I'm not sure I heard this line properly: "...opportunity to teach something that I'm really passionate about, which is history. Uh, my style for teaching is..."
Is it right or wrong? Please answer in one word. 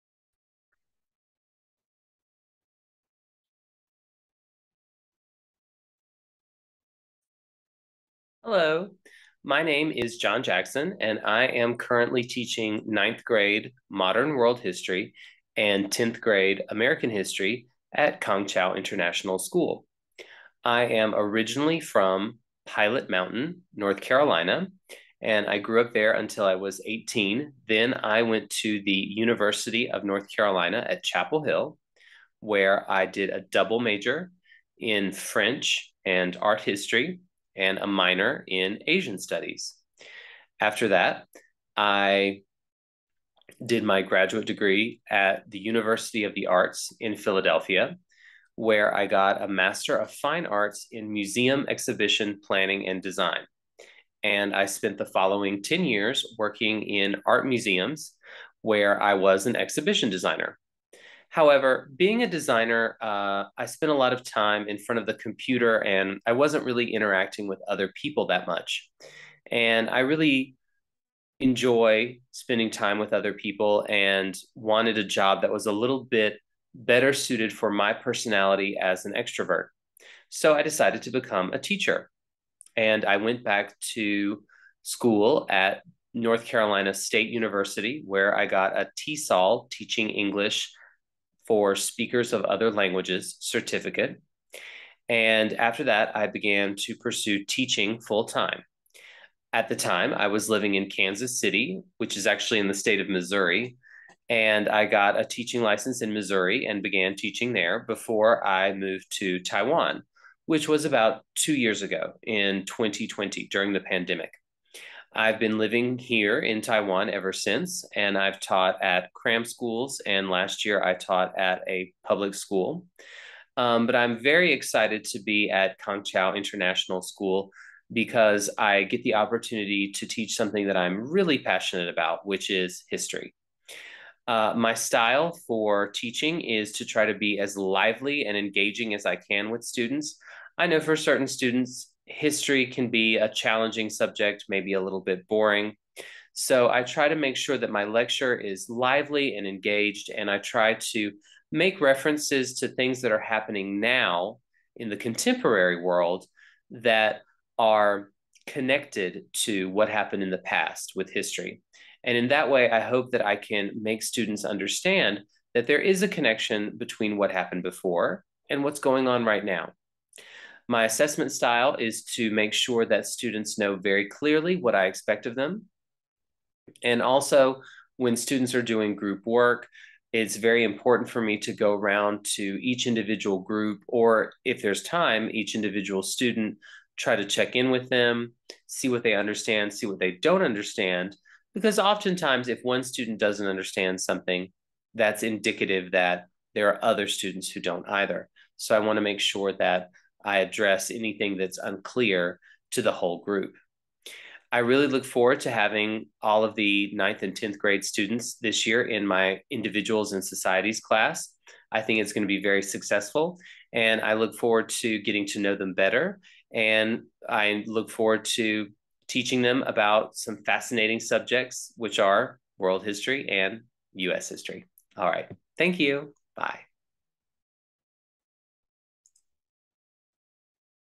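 right.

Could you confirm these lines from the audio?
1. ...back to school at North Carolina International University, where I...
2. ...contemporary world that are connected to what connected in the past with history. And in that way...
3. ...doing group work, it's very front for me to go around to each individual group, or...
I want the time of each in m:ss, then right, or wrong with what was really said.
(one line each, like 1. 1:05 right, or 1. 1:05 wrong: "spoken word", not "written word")
1. 1:23 wrong: "State", not "International"
2. 2:34 wrong: "happened", not "connected"
3. 2:58 wrong: "important", not "front".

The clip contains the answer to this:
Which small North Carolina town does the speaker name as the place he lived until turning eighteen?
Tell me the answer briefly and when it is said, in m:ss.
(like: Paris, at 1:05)
Pilot Mountain, at 0:22.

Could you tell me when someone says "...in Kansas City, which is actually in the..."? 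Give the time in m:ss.
1:40.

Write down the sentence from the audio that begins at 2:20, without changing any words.
I know for certain students, history can be a challenging subject, maybe a little bit boring.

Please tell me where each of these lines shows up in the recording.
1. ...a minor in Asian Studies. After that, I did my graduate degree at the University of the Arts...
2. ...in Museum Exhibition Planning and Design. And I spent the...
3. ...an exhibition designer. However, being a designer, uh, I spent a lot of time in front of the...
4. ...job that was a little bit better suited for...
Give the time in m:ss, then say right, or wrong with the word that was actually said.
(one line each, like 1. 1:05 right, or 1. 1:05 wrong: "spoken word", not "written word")
1. 0:37 right
2. 0:50 right
3. 0:59 right
4. 1:15 right.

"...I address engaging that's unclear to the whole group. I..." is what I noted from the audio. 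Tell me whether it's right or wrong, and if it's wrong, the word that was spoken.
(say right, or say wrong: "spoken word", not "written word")
wrong: "anything", not "engaging".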